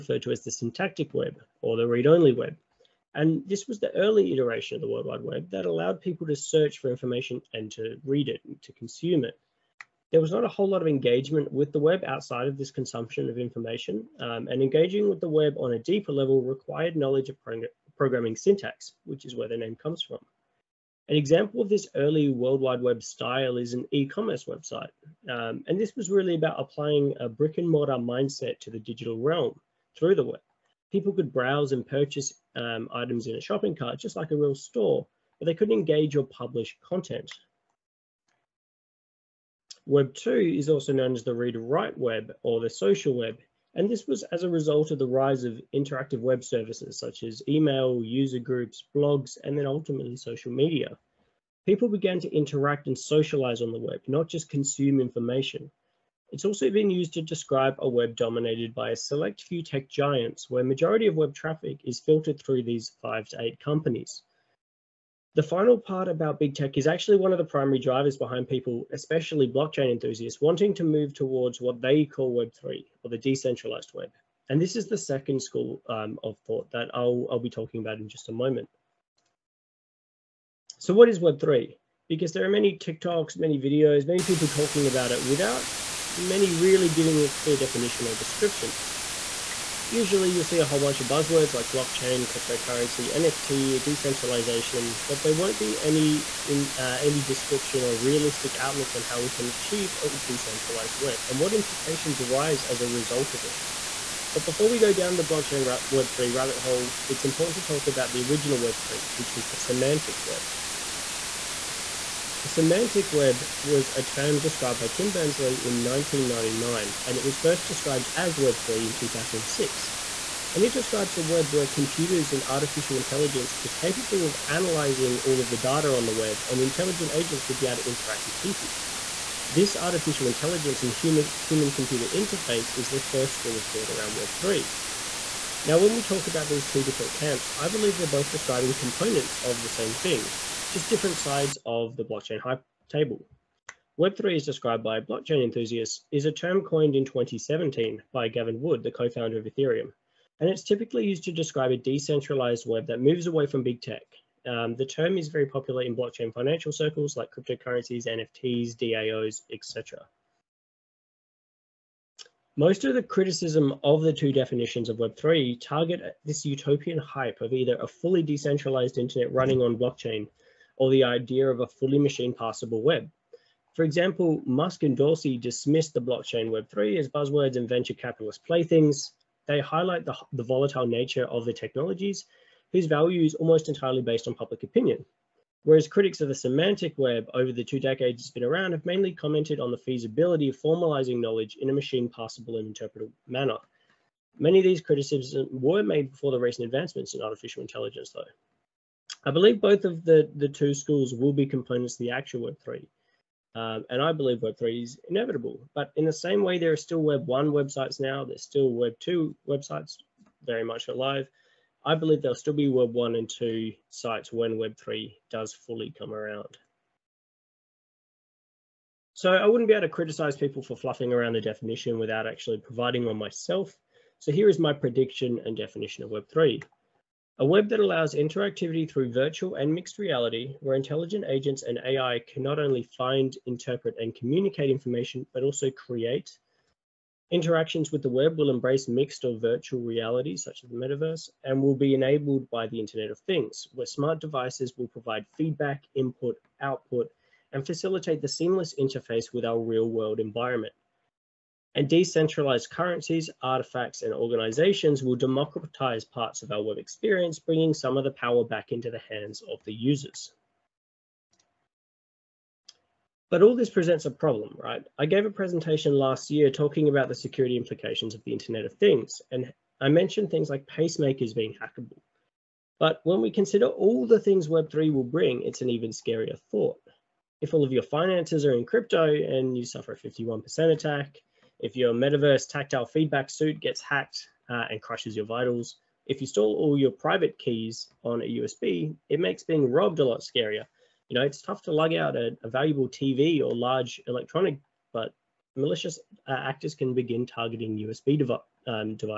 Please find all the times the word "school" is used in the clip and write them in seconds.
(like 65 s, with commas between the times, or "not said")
75 s, 133 s, 200 s.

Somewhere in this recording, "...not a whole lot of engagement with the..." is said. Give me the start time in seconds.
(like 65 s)
10 s.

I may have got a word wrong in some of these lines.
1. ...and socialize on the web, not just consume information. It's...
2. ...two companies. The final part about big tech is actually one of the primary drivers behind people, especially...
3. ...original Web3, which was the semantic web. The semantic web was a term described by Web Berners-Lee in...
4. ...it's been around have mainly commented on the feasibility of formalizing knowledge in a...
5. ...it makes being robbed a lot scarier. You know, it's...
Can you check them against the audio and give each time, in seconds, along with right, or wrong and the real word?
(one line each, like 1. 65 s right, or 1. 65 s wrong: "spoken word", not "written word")
1. 52 s right
2. 63 s wrong: "eight", not "two"
3. 108 s wrong: "Tim", not "Web"
4. 188 s right
5. 289 s right.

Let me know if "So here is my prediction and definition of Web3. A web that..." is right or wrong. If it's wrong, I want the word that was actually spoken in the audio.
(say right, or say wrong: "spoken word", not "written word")
right.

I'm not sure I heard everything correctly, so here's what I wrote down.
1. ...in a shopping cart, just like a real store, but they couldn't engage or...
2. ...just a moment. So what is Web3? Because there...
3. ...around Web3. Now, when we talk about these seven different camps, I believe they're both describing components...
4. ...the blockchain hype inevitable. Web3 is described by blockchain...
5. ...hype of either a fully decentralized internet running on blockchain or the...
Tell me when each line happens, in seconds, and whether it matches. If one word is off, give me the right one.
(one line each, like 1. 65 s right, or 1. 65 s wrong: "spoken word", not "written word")
1. 33 s right
2. 78 s right
3. 133 s wrong: "two", not "seven"
4. 141 s wrong: "table", not "inevitable"
5. 166 s right.